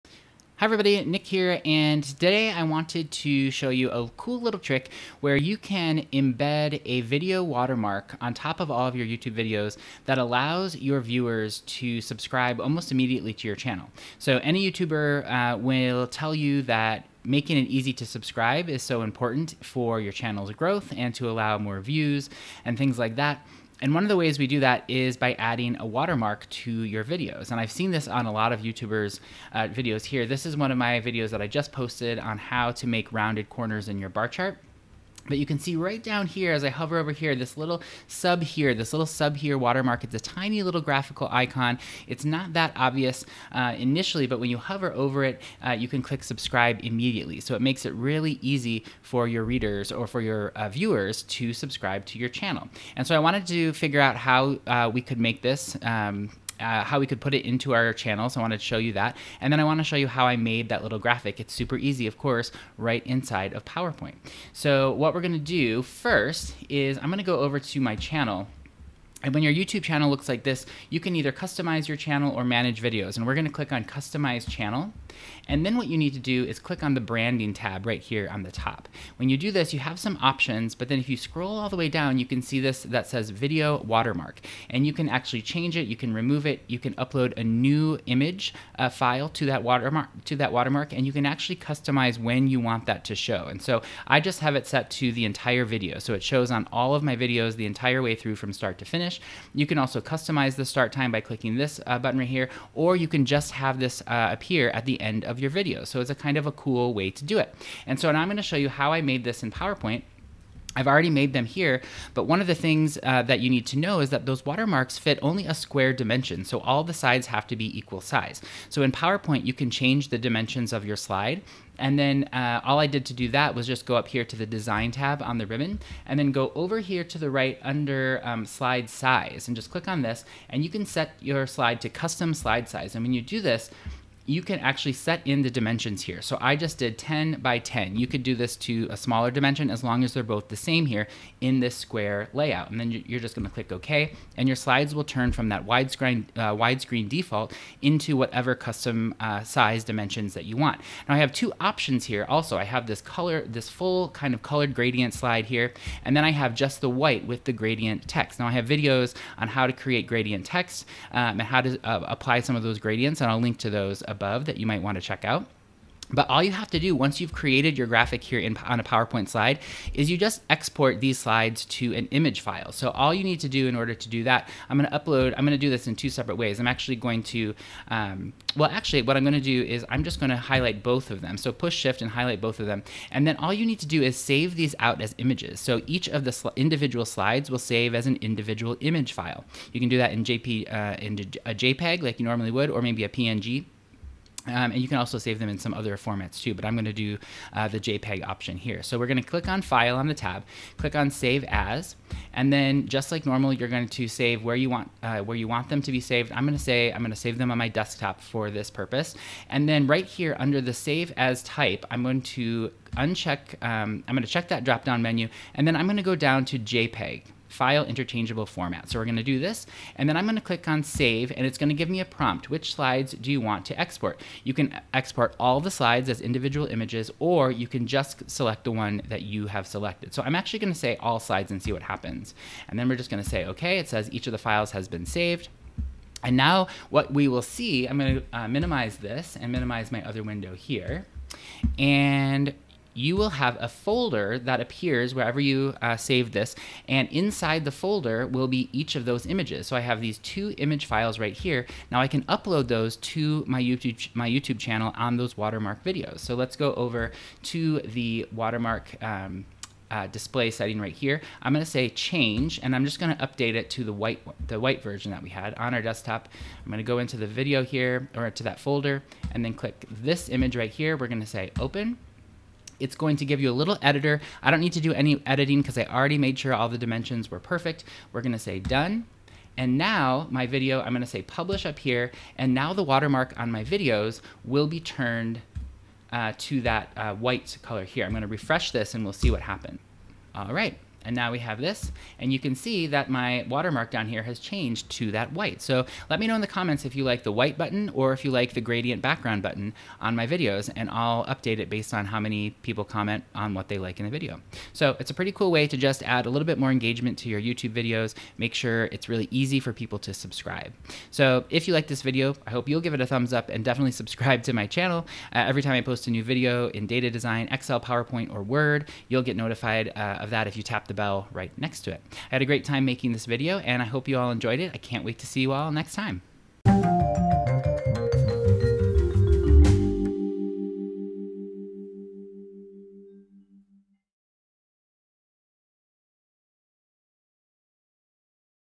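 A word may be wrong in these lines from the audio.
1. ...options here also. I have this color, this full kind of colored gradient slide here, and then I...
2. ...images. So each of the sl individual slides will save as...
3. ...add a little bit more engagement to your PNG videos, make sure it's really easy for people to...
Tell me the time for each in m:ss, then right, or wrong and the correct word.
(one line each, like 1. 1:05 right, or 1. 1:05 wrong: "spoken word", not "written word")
1. 2:31 right
2. 3:05 right
3. 5:06 wrong: "YouTube", not "PNG".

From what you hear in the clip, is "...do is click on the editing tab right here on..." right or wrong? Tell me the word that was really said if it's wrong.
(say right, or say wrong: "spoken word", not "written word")
wrong: "branding", not "editing".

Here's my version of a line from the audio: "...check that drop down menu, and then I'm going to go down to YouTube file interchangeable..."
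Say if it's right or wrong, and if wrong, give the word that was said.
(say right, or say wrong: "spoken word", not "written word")
wrong: "JPEG", not "YouTube".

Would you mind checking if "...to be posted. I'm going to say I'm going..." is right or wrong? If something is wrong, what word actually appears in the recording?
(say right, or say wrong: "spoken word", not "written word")
wrong: "saved", not "posted".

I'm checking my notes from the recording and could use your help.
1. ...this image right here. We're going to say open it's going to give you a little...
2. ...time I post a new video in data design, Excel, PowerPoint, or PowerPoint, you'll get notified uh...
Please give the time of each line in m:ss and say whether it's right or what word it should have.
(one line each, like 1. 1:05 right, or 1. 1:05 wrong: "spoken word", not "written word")
1. 4:29 right
2. 5:15 wrong: "Word", not "PowerPoint".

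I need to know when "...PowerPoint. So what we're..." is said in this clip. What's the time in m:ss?
1:03.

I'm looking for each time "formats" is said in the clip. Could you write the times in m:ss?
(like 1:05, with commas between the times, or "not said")
3:15, 3:38.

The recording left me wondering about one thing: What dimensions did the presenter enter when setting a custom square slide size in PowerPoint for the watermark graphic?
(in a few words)
10 by 10.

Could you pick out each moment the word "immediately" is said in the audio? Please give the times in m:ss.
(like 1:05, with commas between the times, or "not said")
0:12, 0:46.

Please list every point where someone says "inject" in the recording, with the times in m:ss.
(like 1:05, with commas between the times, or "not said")
not said.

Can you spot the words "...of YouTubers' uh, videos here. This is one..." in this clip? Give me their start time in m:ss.
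0:28.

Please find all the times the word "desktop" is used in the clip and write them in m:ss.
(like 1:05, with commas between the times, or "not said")
3:27, 4:25.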